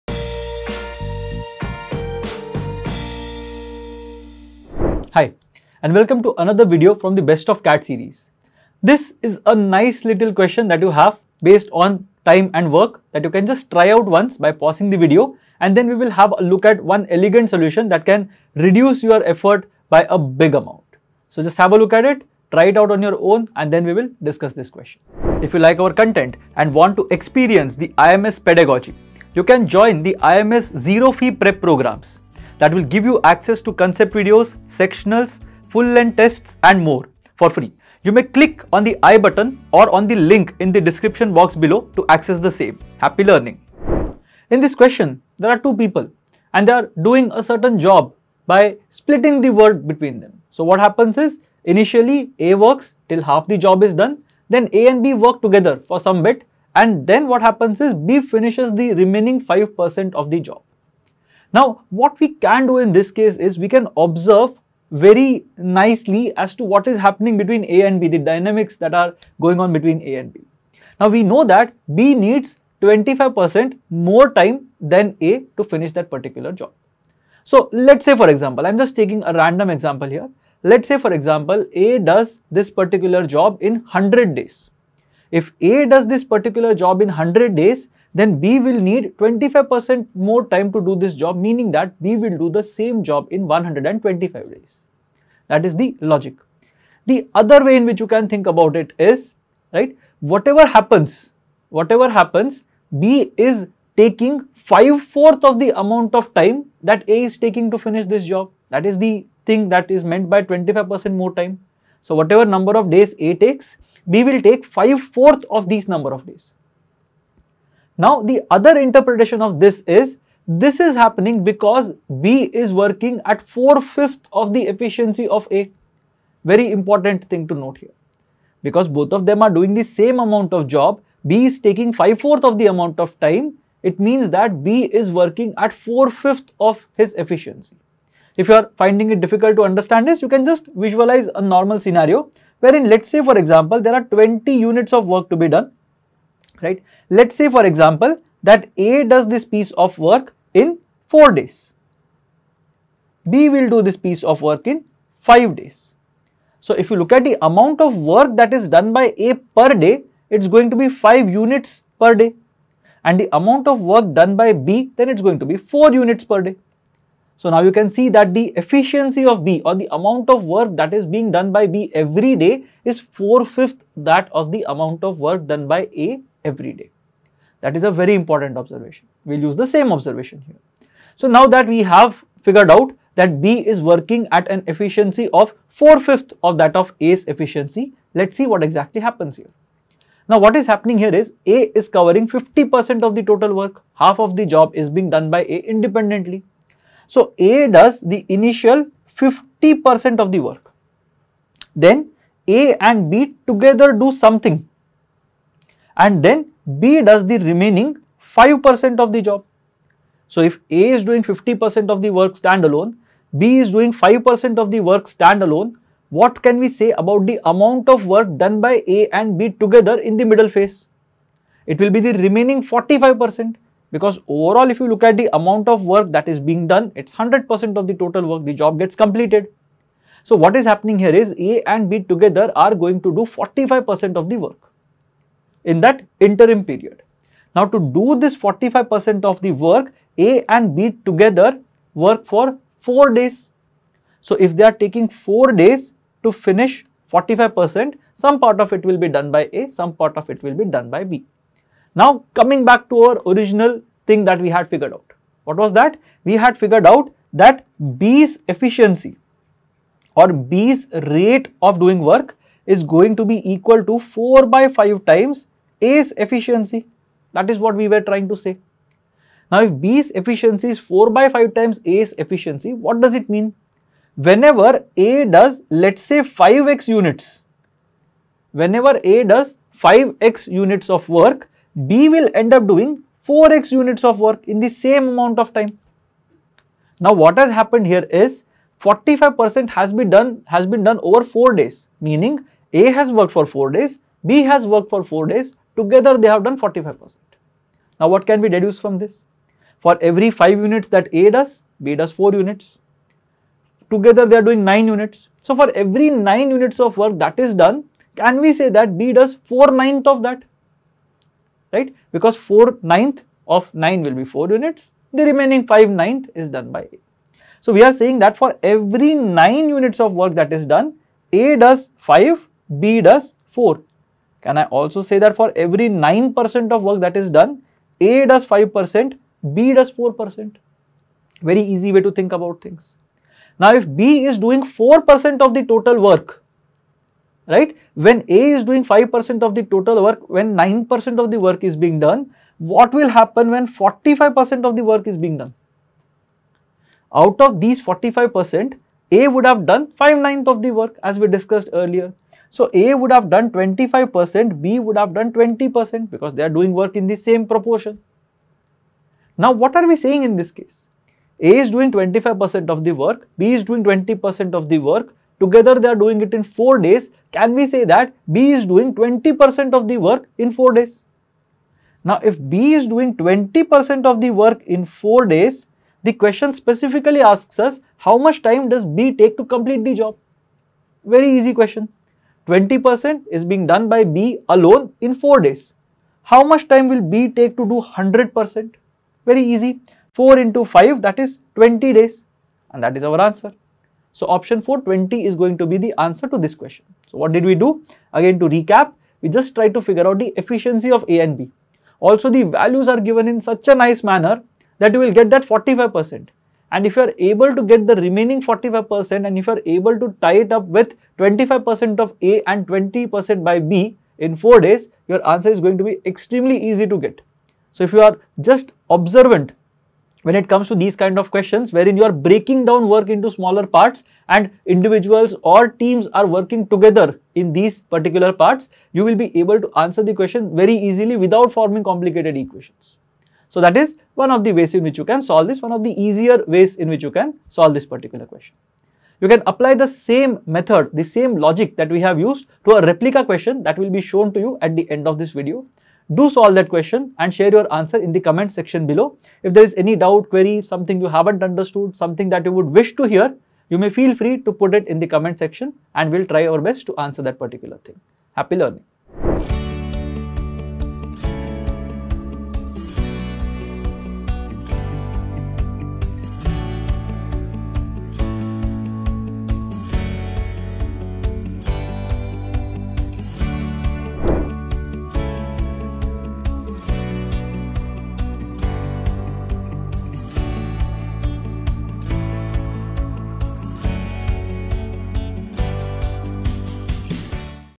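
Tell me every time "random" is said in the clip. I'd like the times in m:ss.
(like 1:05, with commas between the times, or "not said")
1:19.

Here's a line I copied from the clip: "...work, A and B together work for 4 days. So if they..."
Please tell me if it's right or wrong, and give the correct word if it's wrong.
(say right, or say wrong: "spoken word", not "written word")
right.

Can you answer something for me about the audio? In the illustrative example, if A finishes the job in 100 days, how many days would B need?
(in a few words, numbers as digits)
125 days.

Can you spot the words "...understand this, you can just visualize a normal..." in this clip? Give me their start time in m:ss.
2:19.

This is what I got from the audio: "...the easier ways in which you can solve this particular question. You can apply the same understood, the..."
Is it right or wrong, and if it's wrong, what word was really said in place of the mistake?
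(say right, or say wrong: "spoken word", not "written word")
wrong: "method", not "understood".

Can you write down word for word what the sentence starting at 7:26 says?
Do solve that question and share your answer in the comment section below.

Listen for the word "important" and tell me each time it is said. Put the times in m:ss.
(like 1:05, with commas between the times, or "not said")
2:06, 2:58.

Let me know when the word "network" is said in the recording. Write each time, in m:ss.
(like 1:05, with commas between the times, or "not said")
not said.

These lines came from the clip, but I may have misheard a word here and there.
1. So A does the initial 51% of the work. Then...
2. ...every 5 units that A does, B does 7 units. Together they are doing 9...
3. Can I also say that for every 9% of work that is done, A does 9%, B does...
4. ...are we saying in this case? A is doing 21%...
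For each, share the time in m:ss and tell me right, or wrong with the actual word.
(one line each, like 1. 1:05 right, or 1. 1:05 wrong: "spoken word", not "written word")
1. 3:17 wrong: "50", not "51"
2. 5:00 wrong: "4", not "7"
3. 5:24 wrong: "5", not "9"
4. 5:59 wrong: "25", not "21".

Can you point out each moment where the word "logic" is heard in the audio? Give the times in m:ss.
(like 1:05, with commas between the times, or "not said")
1:36, 7:21.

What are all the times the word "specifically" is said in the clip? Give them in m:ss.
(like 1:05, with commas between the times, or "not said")
6:16.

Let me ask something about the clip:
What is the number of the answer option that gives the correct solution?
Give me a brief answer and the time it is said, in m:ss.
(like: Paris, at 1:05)
4, at 6:34.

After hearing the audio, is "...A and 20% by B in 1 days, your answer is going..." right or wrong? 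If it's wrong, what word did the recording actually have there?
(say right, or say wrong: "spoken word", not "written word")
wrong: "4", not "1".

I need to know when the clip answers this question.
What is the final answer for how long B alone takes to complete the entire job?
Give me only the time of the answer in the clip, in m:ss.
6:31.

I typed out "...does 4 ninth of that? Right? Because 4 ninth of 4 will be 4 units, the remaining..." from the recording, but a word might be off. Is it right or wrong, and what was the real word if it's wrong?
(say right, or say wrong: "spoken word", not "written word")
wrong: "9", not "4".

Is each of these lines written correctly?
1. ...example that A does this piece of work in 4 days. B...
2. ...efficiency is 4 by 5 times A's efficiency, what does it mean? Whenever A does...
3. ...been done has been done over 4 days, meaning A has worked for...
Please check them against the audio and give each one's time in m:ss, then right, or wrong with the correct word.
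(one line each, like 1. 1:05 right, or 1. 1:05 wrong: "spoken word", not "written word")
1. 2:27 right
2. 4:30 right
3. 4:49 right.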